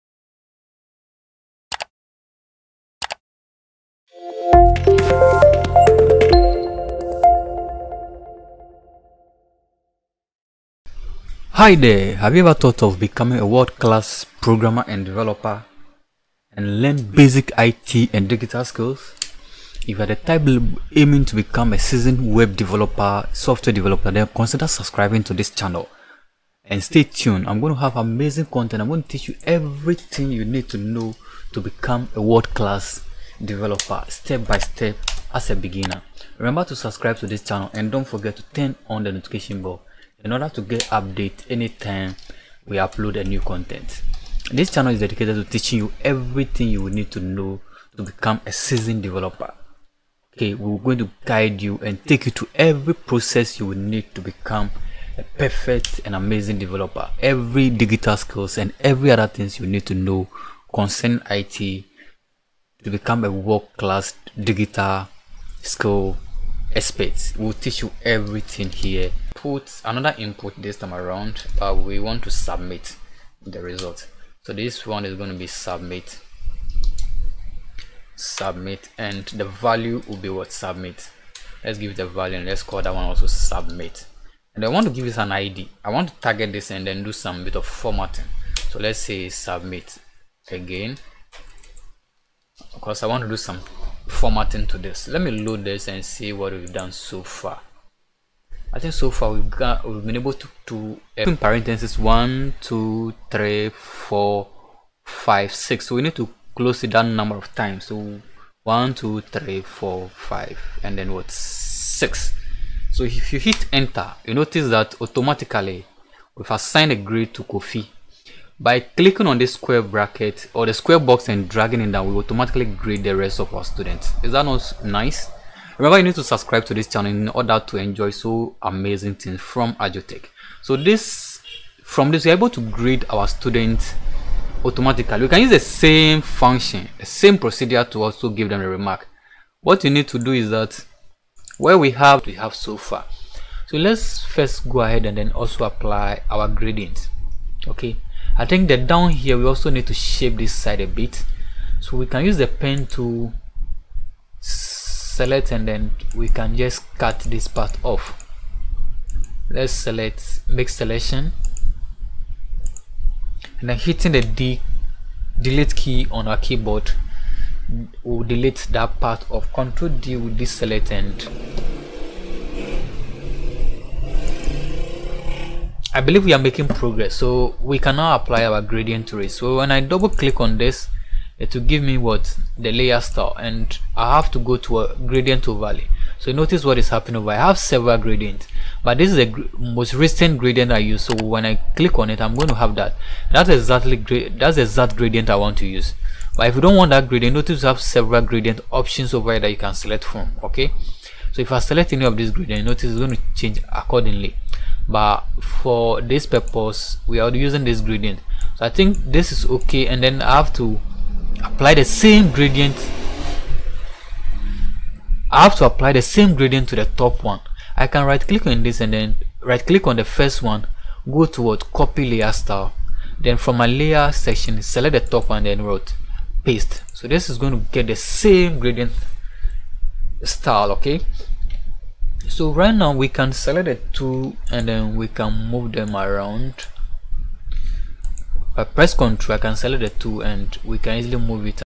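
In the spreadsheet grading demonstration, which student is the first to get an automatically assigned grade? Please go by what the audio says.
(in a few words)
Kofi.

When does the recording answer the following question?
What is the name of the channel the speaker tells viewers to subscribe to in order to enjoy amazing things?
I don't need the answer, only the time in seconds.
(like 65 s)
129 s.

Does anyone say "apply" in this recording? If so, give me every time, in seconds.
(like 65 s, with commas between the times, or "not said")
145 s, 178 s, 211 s, 215 s.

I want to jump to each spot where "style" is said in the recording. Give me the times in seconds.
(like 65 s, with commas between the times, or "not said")
183 s, 222 s, 230 s.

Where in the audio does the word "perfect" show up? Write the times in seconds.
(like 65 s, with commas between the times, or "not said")
55 s.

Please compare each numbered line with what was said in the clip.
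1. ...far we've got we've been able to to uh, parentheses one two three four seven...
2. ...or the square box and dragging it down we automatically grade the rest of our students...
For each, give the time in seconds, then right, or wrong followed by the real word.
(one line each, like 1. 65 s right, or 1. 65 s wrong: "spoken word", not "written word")
1. 99 s wrong: "five", not "seven"
2. 120 s right.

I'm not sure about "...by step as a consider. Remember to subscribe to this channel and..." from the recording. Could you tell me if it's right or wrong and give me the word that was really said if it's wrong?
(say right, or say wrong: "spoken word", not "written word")
wrong: "beginner", not "consider".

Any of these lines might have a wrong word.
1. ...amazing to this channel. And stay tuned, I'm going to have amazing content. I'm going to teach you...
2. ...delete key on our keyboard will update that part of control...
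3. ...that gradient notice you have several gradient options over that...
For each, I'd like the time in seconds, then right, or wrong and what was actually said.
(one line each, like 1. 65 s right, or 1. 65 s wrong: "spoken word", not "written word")
1. 24 s wrong: "subscribing", not "amazing"
2. 165 s wrong: "delete", not "update"
3. 196 s right.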